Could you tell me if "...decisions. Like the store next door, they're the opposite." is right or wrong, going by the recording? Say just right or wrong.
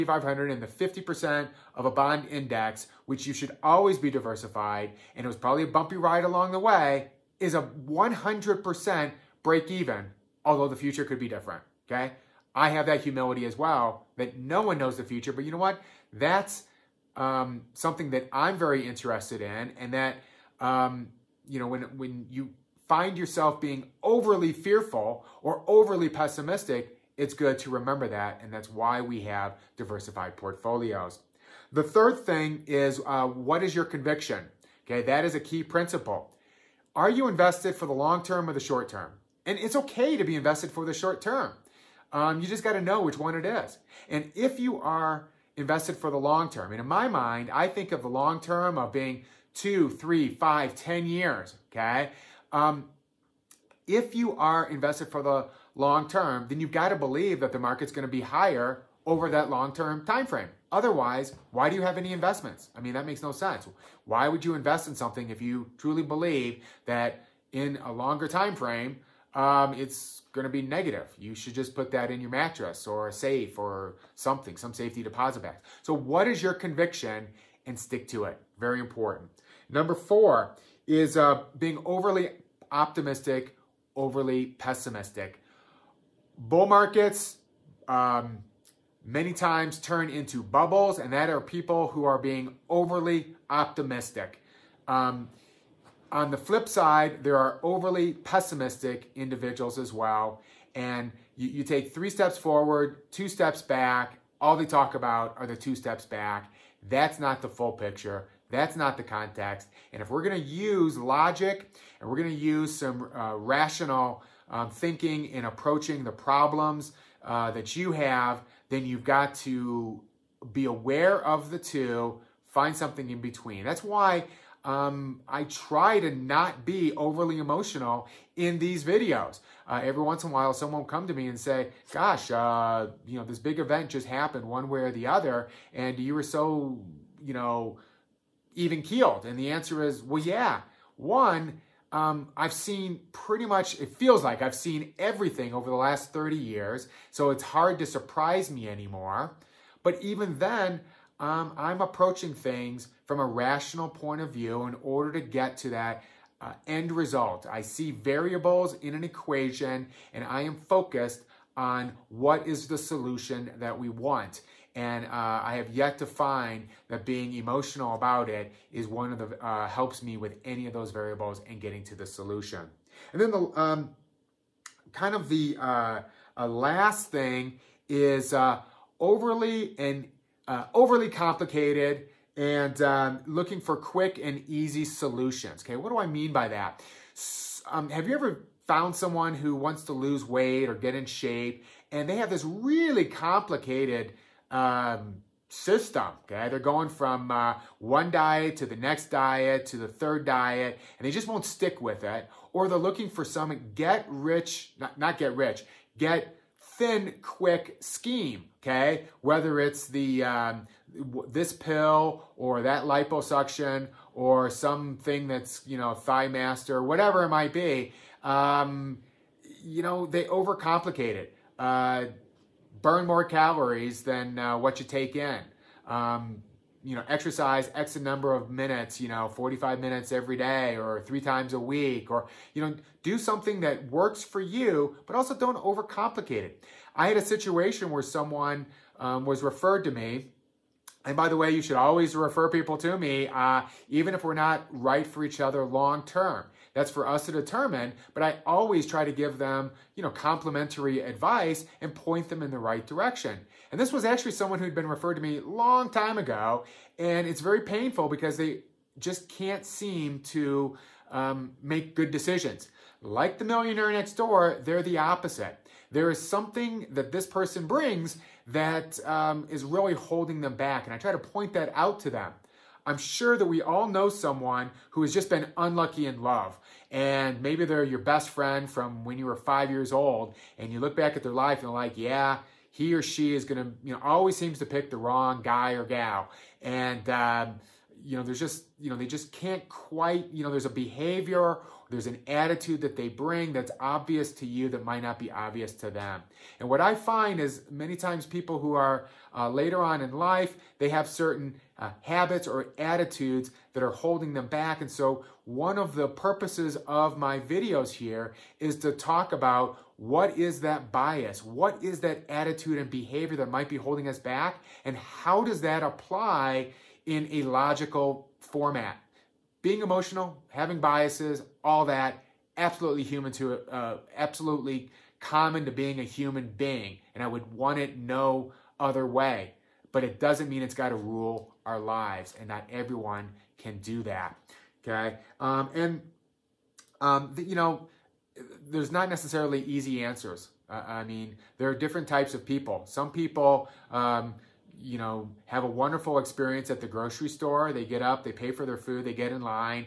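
wrong.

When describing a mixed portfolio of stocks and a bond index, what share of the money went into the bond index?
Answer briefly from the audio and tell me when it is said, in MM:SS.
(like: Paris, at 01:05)
50%, at 00:00.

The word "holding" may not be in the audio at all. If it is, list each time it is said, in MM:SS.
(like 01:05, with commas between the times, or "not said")
04:29, 05:03, 05:13.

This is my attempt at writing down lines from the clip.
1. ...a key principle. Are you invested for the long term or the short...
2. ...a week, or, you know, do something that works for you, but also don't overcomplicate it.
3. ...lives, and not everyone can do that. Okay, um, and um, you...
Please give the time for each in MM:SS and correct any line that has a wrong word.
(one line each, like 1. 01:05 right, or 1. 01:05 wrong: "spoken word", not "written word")
1. 00:35 right
2. 03:51 right
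3. 05:31 right.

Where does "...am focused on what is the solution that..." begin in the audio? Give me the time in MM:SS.
02:40.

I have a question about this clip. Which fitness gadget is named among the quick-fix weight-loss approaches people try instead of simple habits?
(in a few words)
Thigh Master.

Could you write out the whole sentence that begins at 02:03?
That's why um, I try to not be overly emotional in these videos.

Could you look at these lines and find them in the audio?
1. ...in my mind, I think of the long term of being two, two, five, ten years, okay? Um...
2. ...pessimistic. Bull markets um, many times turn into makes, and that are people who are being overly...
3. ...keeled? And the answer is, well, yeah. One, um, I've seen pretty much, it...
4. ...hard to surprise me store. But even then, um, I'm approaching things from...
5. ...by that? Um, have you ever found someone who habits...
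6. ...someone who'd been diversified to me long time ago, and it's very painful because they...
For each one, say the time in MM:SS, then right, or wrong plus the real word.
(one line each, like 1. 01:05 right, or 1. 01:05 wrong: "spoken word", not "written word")
1. 00:46 wrong: "three", not "two"
2. 01:24 wrong: "bubbles", not "makes"
3. 02:18 right
4. 02:27 wrong: "anymore", not "store"
5. 03:06 wrong: "wants", not "habits"
6. 04:14 wrong: "referred", not "diversified".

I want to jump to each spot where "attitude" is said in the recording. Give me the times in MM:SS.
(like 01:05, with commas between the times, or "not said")
04:52, 05:02, 05:12.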